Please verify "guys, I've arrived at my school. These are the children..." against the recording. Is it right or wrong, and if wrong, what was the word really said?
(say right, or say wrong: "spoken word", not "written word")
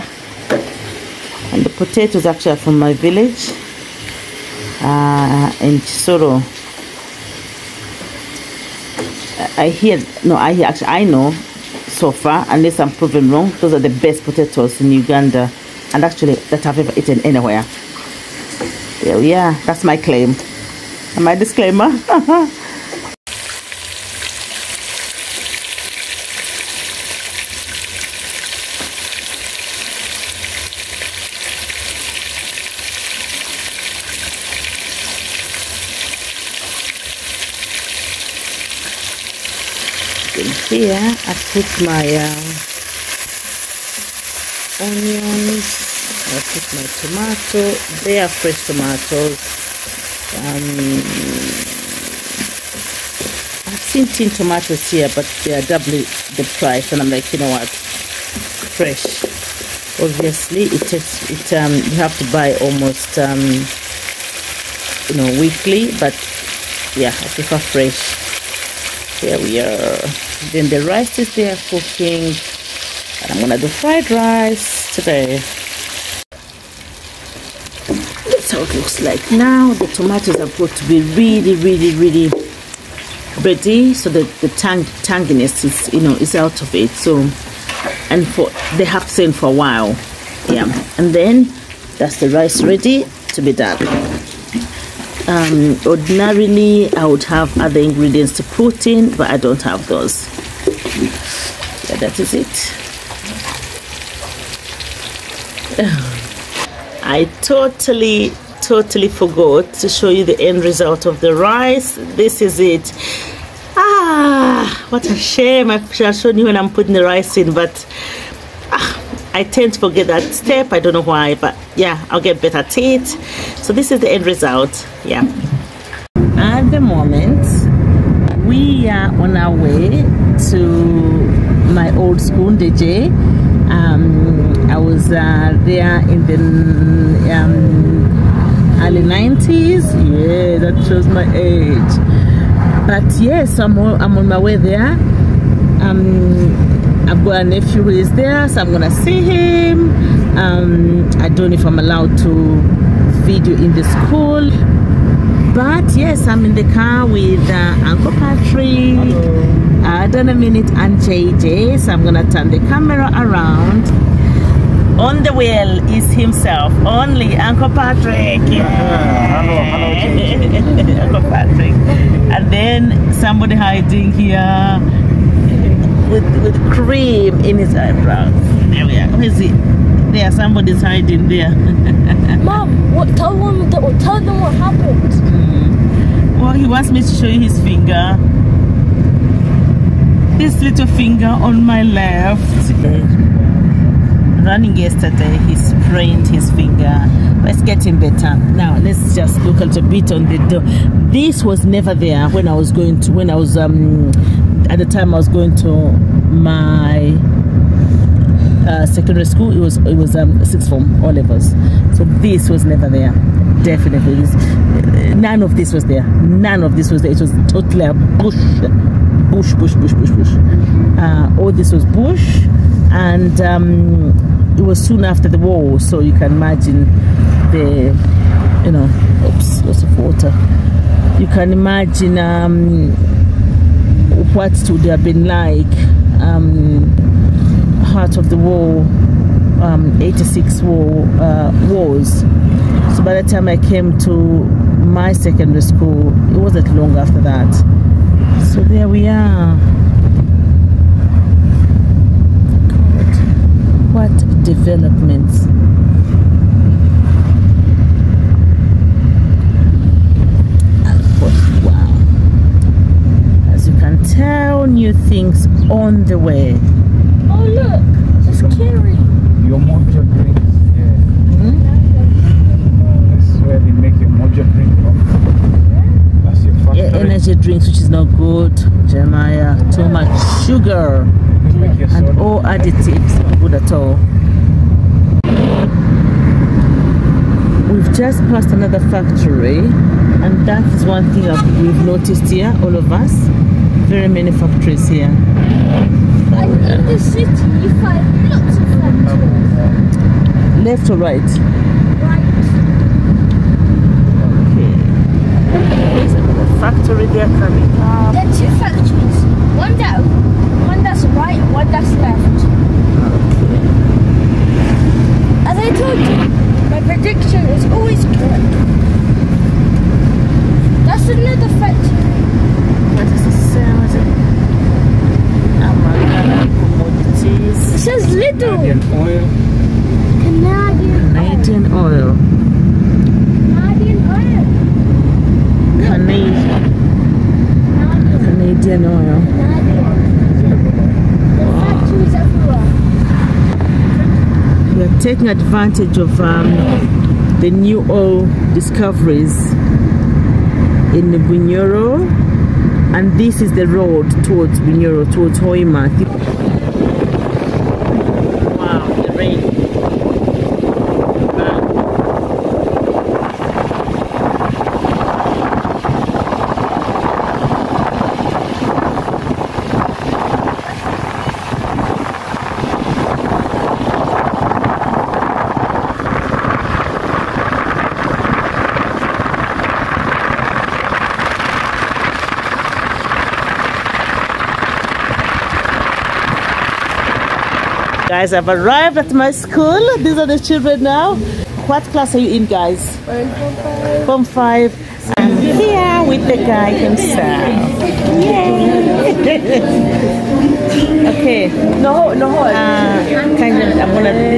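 right.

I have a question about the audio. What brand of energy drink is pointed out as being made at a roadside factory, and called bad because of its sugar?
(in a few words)
Mojo.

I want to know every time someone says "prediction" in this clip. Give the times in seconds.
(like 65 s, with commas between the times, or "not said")
316 s.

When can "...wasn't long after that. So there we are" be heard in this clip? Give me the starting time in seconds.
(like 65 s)
246 s.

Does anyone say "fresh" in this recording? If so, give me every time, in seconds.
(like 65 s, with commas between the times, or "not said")
48 s, 57 s, 67 s.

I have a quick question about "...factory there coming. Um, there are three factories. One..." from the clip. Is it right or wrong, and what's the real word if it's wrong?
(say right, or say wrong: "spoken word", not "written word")
wrong: "two", not "three".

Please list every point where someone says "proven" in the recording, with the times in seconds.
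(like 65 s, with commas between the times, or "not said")
12 s.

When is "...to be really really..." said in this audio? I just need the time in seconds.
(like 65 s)
80 s.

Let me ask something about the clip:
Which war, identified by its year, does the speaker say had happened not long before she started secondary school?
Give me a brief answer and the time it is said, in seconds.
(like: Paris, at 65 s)
86 war, at 239 s.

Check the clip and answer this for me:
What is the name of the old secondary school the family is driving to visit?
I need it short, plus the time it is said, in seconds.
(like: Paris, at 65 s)
Ndejje, at 132 s.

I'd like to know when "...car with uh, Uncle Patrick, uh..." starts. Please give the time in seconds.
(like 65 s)
156 s.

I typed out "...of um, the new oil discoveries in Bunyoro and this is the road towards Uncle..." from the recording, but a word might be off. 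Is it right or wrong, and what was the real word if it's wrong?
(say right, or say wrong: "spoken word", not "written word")
wrong: "Bunyoro", not "Uncle".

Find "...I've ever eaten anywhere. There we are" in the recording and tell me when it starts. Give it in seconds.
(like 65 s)
16 s.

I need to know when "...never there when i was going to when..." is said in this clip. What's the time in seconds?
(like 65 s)
201 s.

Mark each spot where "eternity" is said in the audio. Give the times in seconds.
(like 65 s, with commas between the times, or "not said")
not said.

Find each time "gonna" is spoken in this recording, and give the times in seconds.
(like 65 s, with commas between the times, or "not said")
73 s, 148 s, 162 s.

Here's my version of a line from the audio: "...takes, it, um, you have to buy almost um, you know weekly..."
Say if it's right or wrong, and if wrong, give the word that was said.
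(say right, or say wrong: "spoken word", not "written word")
right.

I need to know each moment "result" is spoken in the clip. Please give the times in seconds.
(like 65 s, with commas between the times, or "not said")
110 s, 124 s.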